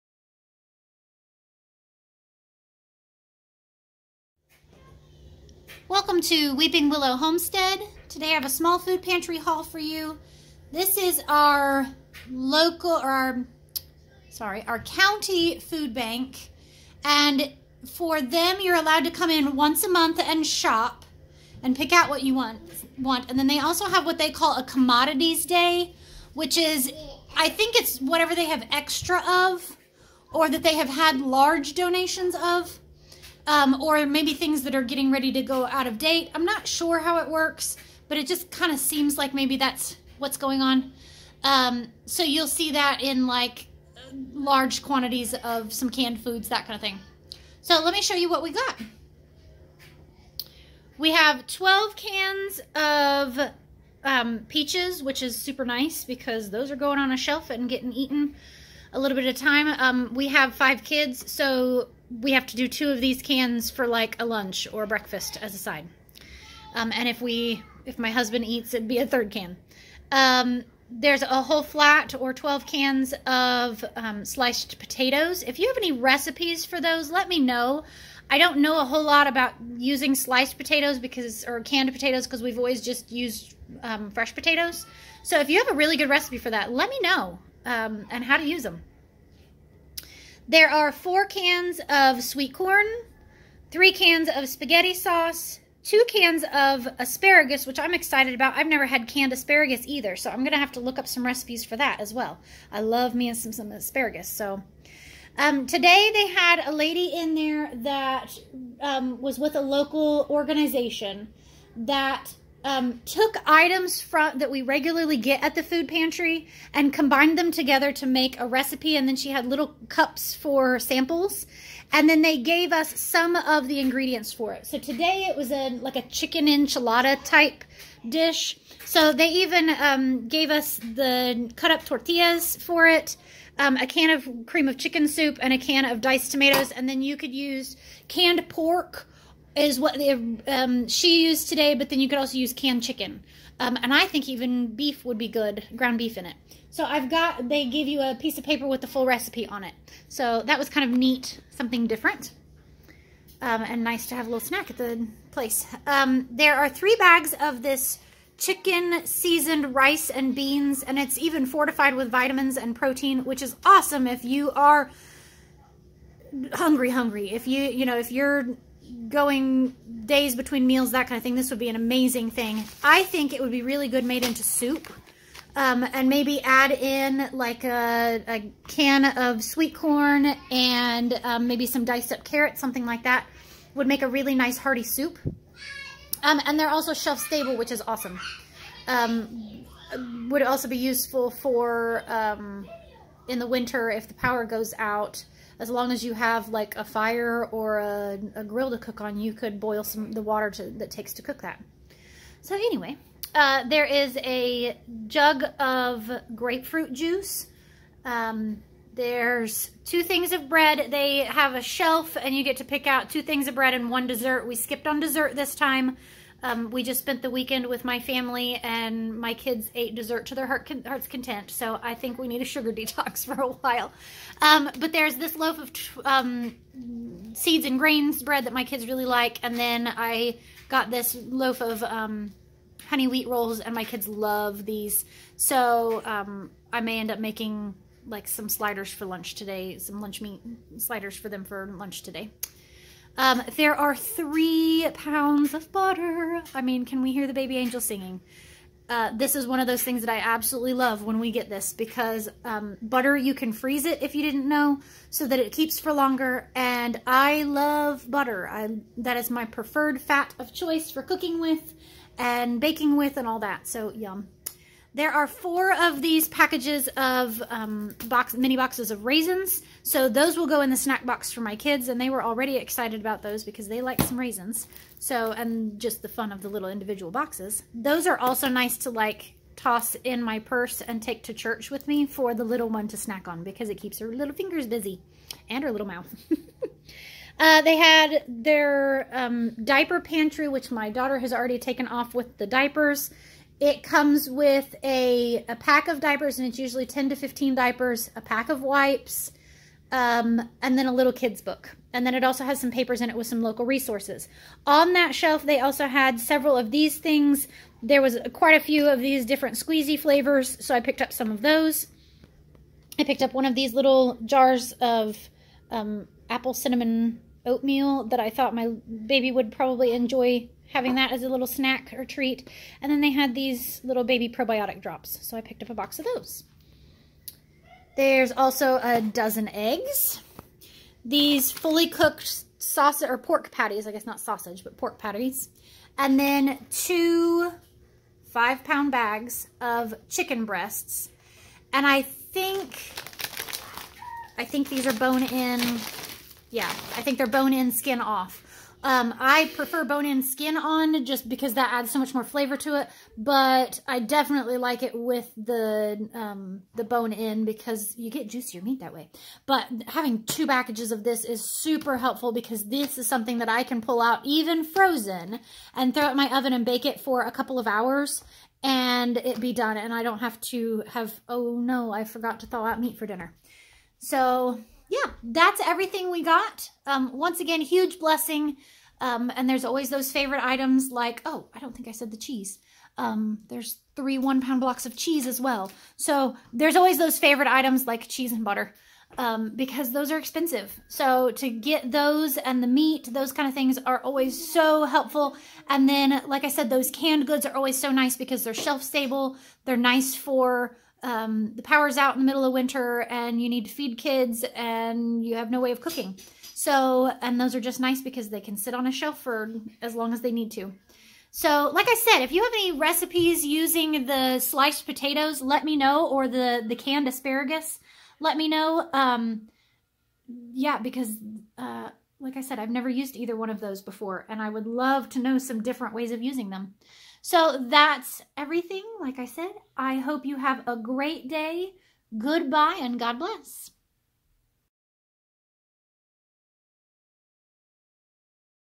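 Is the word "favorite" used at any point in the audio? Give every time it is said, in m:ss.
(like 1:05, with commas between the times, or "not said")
6:20, 6:27.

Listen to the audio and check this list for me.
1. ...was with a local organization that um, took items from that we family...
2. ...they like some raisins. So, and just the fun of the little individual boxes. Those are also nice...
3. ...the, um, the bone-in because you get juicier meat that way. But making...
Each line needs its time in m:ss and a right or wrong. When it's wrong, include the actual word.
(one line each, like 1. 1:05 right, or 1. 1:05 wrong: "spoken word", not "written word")
1. 1:49 wrong: "regularly", not "family"
2. 4:33 right
3. 5:55 wrong: "having", not "making".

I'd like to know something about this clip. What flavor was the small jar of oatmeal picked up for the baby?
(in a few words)
apple cinnamon.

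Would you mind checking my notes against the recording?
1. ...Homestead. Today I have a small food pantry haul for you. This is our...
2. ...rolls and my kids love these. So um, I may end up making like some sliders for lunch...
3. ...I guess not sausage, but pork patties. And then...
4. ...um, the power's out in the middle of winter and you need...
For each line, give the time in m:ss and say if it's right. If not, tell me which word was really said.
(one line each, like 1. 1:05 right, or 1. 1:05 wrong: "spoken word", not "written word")
1. 0:07 right
2. 3:53 right
3. 5:33 right
4. 6:41 right.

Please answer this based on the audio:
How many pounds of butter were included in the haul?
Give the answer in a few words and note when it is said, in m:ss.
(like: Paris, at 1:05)
3, at 4:03.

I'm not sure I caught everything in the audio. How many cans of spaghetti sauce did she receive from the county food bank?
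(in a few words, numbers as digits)
3.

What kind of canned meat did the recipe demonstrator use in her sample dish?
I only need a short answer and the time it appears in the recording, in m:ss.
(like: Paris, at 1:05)
canned pork, at 2:18.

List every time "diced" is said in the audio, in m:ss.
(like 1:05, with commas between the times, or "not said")
2:15, 3:01.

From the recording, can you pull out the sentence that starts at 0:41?
Um, so you'll see that in like large quantities of some canned foods, that kind of thing.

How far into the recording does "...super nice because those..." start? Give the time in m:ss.
0:55.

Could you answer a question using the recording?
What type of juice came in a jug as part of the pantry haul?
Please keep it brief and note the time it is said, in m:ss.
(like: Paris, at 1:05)
grapefruit juice, at 3:26.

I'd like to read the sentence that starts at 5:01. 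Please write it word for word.
And then it also has some papers in it with some local resources.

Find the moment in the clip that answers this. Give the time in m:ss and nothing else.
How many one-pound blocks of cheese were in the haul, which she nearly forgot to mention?
6:23.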